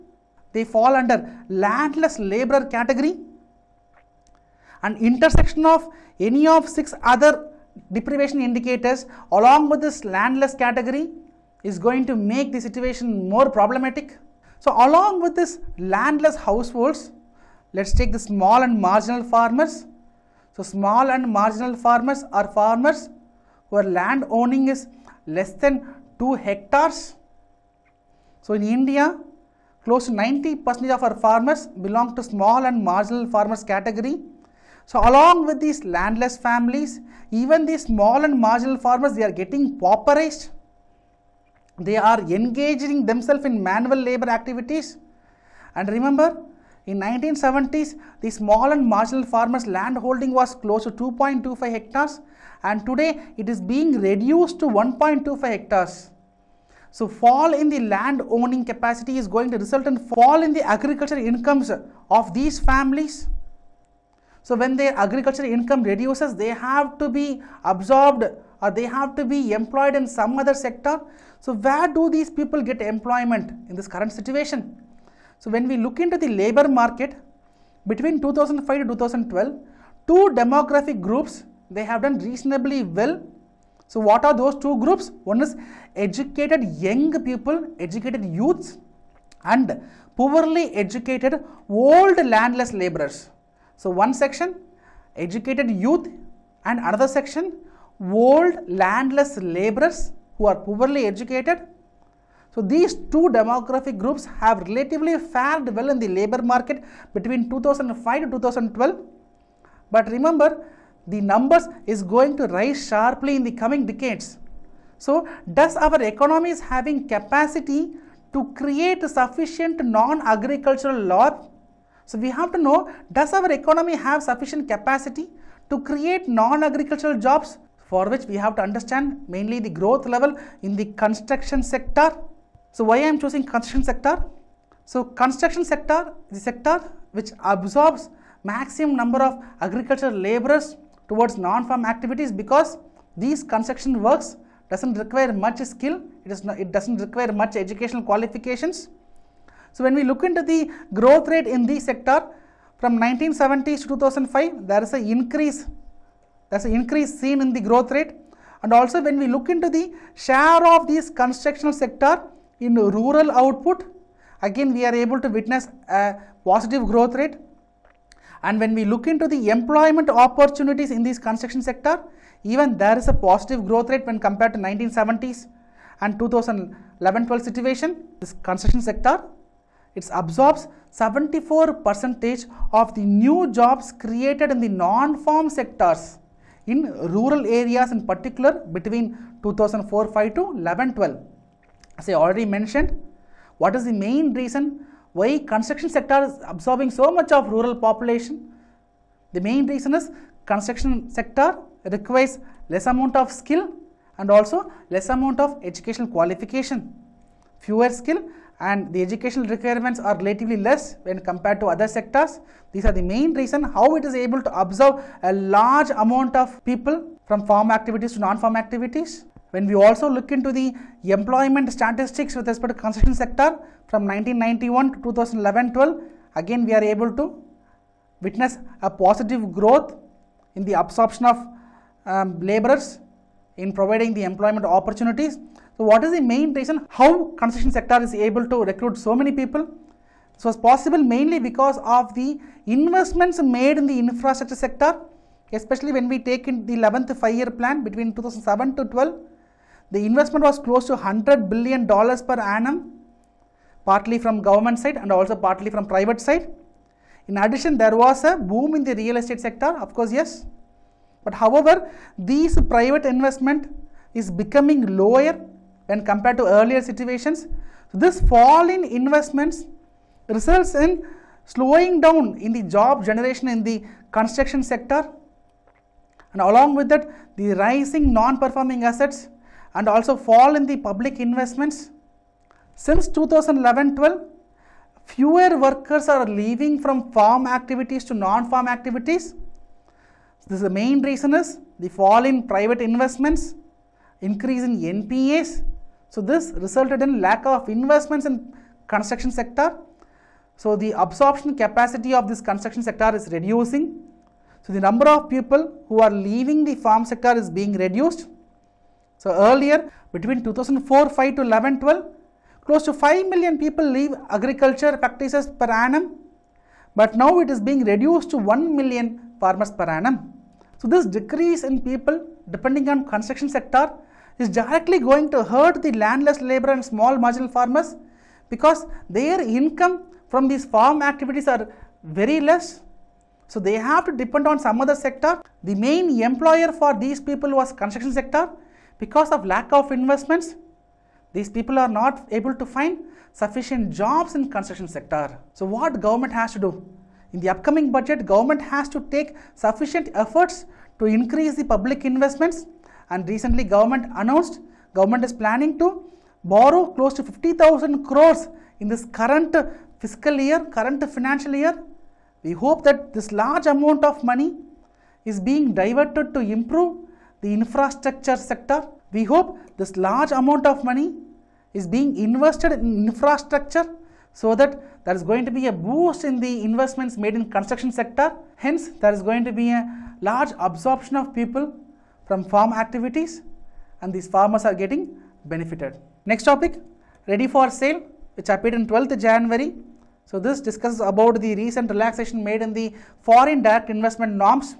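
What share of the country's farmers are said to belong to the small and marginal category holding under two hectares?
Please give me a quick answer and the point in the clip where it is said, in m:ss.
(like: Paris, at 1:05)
90%, at 0:30.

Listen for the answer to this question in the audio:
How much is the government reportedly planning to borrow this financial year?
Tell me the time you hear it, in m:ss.
5:57.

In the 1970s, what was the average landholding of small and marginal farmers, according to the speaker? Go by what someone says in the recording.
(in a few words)
2.25 hectares.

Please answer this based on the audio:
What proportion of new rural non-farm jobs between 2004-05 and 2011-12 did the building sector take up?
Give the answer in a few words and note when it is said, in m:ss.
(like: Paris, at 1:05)
74%, at 3:00.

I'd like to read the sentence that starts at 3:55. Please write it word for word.
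So what is the main reason how construction sector is able to recruit so many people?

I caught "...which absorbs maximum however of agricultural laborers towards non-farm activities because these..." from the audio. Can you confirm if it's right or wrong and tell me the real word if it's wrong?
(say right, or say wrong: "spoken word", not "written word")
wrong: "number", not "however".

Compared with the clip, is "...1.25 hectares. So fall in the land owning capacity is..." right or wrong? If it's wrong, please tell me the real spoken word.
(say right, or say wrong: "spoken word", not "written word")
right.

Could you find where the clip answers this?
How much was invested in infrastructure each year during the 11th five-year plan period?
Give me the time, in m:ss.
4:10.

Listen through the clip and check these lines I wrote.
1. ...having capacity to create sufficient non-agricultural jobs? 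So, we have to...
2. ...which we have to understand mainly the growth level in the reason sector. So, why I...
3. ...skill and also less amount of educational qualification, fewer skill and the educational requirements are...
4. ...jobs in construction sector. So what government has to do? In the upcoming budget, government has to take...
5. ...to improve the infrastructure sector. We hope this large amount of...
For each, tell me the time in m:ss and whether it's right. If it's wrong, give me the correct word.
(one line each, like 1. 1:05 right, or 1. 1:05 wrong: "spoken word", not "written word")
1. 1:56 right
2. 2:08 wrong: "construction", not "reason"
3. 3:23 right
4. 5:43 right
5. 6:06 right.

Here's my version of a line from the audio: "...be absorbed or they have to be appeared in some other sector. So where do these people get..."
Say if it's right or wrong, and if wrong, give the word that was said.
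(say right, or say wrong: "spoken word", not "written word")
wrong: "employed", not "appeared".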